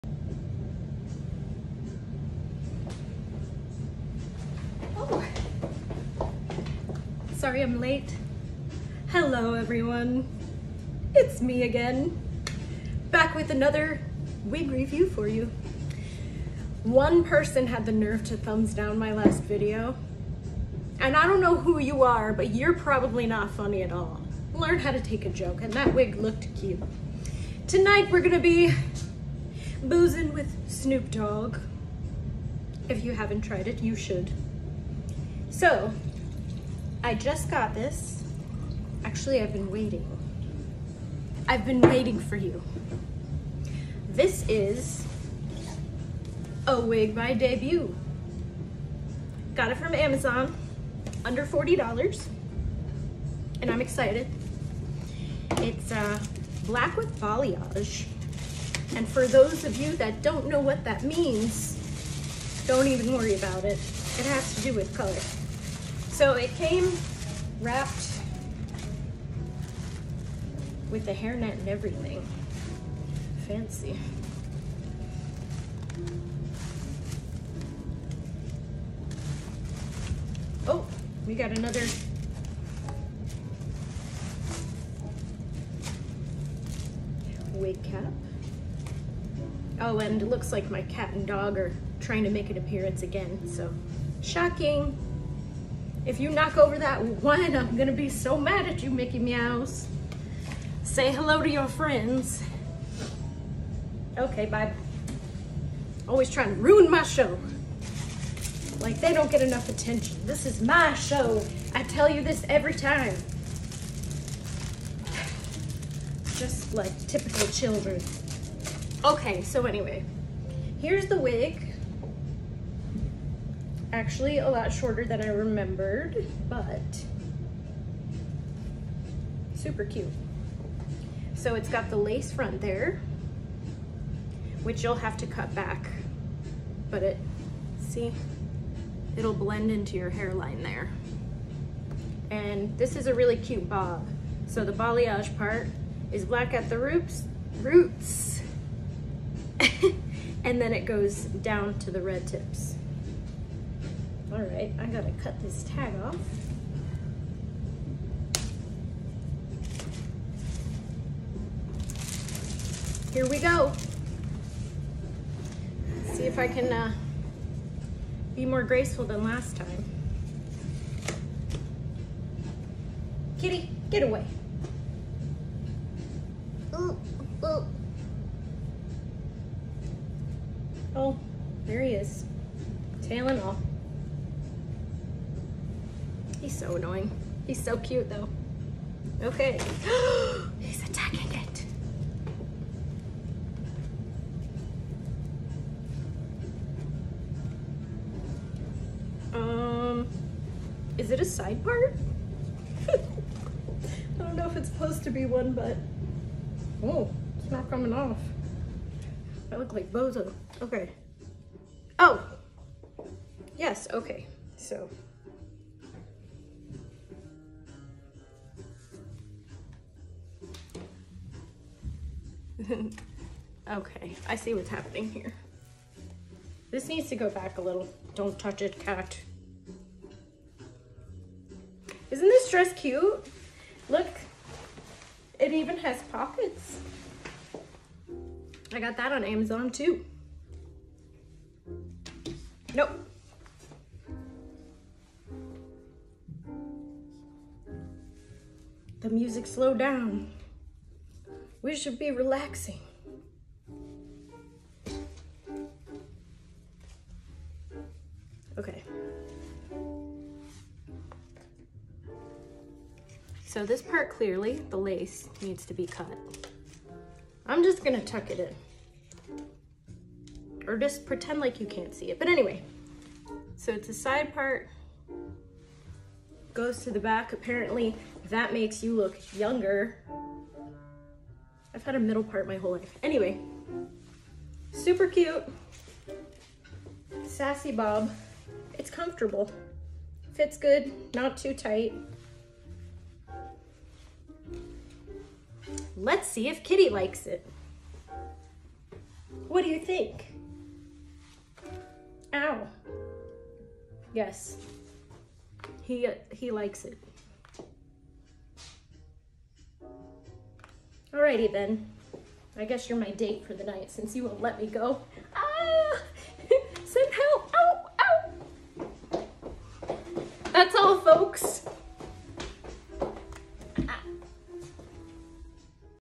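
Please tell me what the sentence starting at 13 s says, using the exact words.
Back with another wig review for you.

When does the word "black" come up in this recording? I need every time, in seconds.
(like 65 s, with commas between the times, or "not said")
56 s, 146 s.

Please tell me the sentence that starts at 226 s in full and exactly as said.
This needs to go back a little.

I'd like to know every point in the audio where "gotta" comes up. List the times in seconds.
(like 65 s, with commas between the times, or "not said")
154 s.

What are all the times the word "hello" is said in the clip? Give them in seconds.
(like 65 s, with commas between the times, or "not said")
9 s, 101 s.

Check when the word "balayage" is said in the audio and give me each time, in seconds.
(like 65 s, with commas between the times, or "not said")
57 s, 144 s.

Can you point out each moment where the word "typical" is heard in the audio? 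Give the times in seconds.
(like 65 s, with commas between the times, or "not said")
117 s.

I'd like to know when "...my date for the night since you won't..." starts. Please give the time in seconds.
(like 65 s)
312 s.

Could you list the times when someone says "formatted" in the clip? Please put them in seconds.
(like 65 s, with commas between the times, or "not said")
not said.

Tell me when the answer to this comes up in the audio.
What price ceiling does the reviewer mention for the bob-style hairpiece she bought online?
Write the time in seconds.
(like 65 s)
51 s.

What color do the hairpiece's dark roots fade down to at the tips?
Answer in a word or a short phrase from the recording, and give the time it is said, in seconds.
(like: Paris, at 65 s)
red, at 152 s.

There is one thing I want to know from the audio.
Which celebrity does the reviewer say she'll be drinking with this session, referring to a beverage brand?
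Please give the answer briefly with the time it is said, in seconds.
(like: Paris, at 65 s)
Snoop Dogg, at 30 s.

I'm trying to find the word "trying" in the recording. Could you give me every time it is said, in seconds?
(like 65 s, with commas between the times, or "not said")
92 s, 106 s.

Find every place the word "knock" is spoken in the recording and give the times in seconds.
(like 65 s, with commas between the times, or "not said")
96 s.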